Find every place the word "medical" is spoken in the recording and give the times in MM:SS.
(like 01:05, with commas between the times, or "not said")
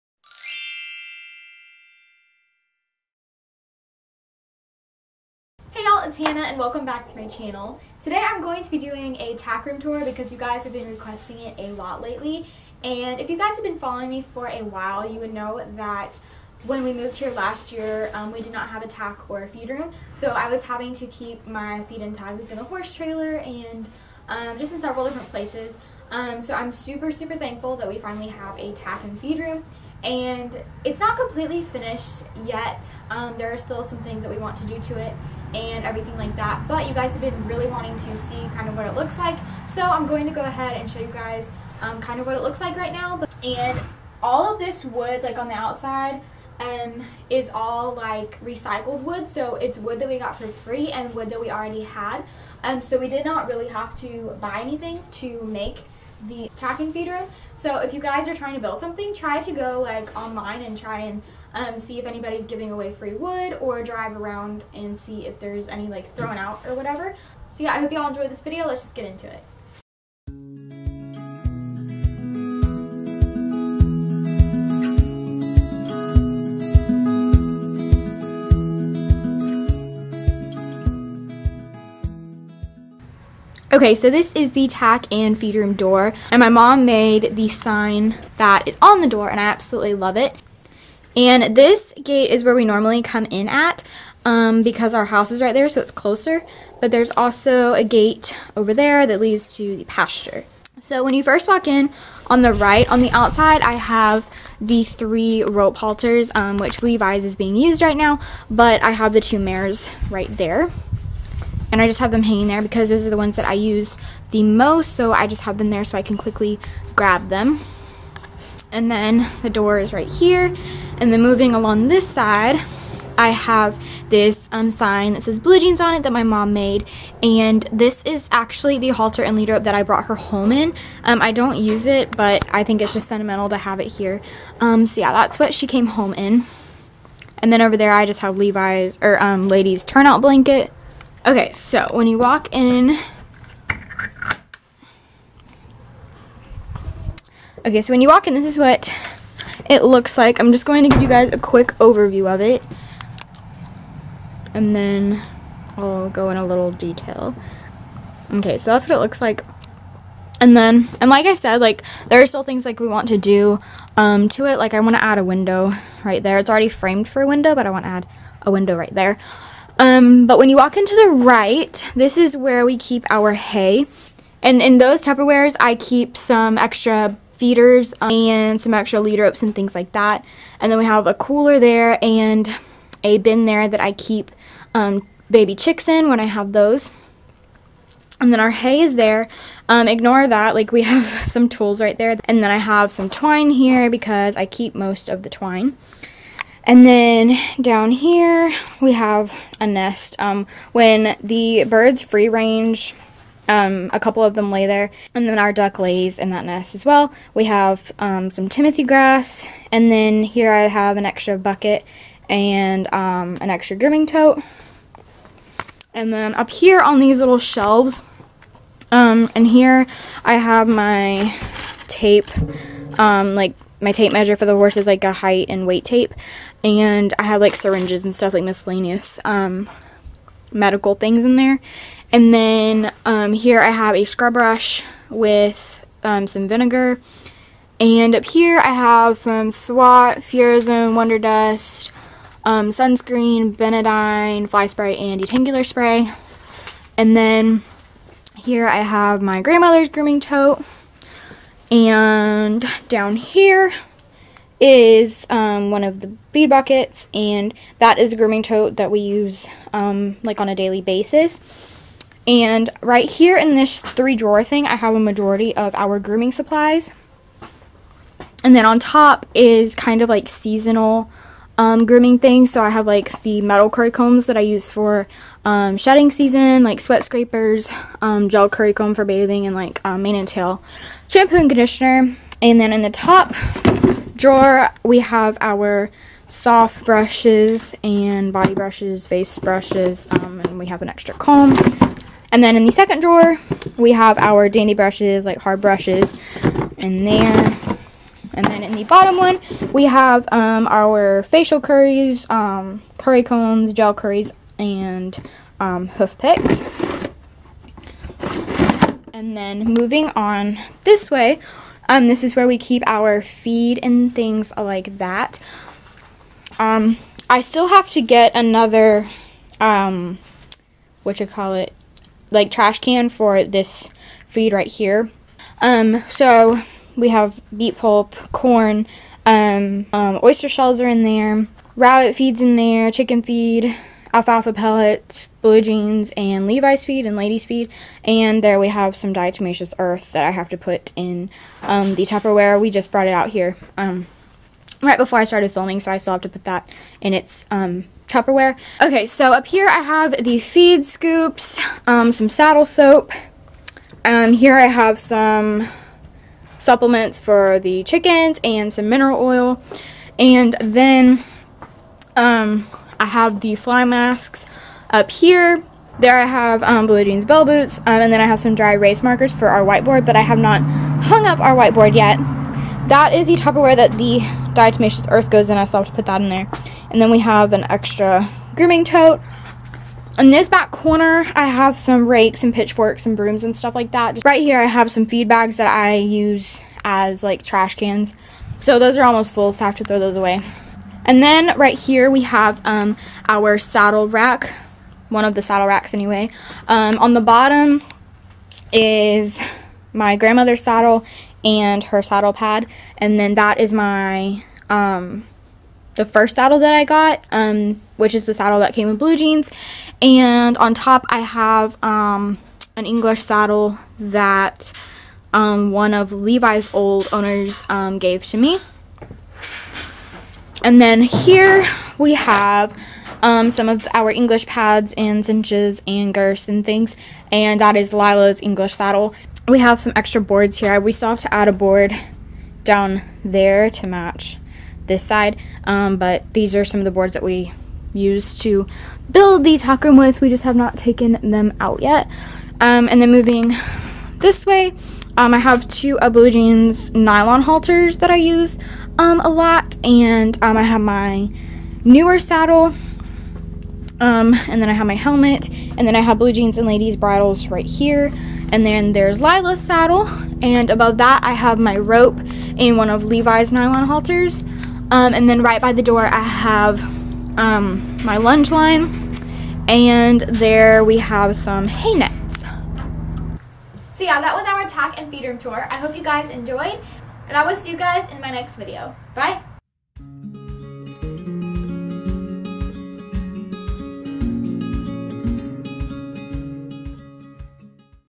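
03:50.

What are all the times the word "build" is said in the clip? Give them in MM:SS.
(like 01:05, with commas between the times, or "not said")
00:58, 07:19.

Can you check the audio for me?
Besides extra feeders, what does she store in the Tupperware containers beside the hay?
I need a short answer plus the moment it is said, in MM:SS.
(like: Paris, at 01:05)
Extra lead ropes, at 02:58.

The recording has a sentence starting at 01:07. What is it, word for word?
So yeah, I hope y'all enjoyed this video.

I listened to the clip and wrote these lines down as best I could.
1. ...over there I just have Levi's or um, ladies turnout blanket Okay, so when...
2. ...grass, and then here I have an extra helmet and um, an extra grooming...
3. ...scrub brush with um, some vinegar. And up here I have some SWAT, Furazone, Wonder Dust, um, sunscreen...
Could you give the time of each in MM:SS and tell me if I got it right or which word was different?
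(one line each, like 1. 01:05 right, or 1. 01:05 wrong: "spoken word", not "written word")
1. 02:17 right
2. 03:28 wrong: "bucket", not "helmet"
3. 03:54 right.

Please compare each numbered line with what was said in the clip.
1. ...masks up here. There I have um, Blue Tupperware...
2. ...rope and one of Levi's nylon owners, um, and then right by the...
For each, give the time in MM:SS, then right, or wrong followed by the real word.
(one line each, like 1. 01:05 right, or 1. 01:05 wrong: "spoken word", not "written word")
1. 06:03 wrong: "Jeans", not "Tupperware"
2. 07:41 wrong: "halters", not "owners".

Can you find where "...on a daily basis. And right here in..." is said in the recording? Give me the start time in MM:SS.
04:20.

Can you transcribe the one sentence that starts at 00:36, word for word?
But you guys have been really wanting to see kind of what it looks like.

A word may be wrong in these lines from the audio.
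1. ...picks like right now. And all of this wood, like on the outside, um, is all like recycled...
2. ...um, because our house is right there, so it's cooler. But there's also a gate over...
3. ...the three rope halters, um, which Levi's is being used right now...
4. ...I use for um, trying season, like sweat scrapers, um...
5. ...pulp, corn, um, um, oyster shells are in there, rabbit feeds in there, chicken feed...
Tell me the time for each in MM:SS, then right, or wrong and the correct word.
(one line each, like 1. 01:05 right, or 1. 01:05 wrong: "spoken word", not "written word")
1. 00:42 wrong: "looks", not "picks"
2. 01:34 wrong: "closer", not "cooler"
3. 01:44 right
4. 04:34 wrong: "shedding", not "trying"
5. 05:27 right.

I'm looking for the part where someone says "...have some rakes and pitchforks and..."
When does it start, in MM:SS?
06:21.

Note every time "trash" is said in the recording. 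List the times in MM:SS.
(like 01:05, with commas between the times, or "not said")
05:22, 06:27.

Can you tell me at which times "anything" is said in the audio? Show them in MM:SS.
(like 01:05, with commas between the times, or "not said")
00:54.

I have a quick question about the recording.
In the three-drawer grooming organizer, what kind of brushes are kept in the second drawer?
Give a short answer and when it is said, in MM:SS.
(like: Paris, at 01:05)
Dandy brushes, at 04:54.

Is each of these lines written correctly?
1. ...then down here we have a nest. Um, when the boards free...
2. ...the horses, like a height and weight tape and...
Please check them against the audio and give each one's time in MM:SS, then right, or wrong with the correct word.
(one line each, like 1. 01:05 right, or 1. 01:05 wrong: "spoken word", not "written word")
1. 03:16 wrong: "birds", not "boards"
2. 03:44 right.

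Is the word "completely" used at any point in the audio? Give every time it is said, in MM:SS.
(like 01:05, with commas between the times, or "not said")
00:31.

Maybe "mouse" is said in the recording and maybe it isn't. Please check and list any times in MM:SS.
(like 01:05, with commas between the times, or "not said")
not said.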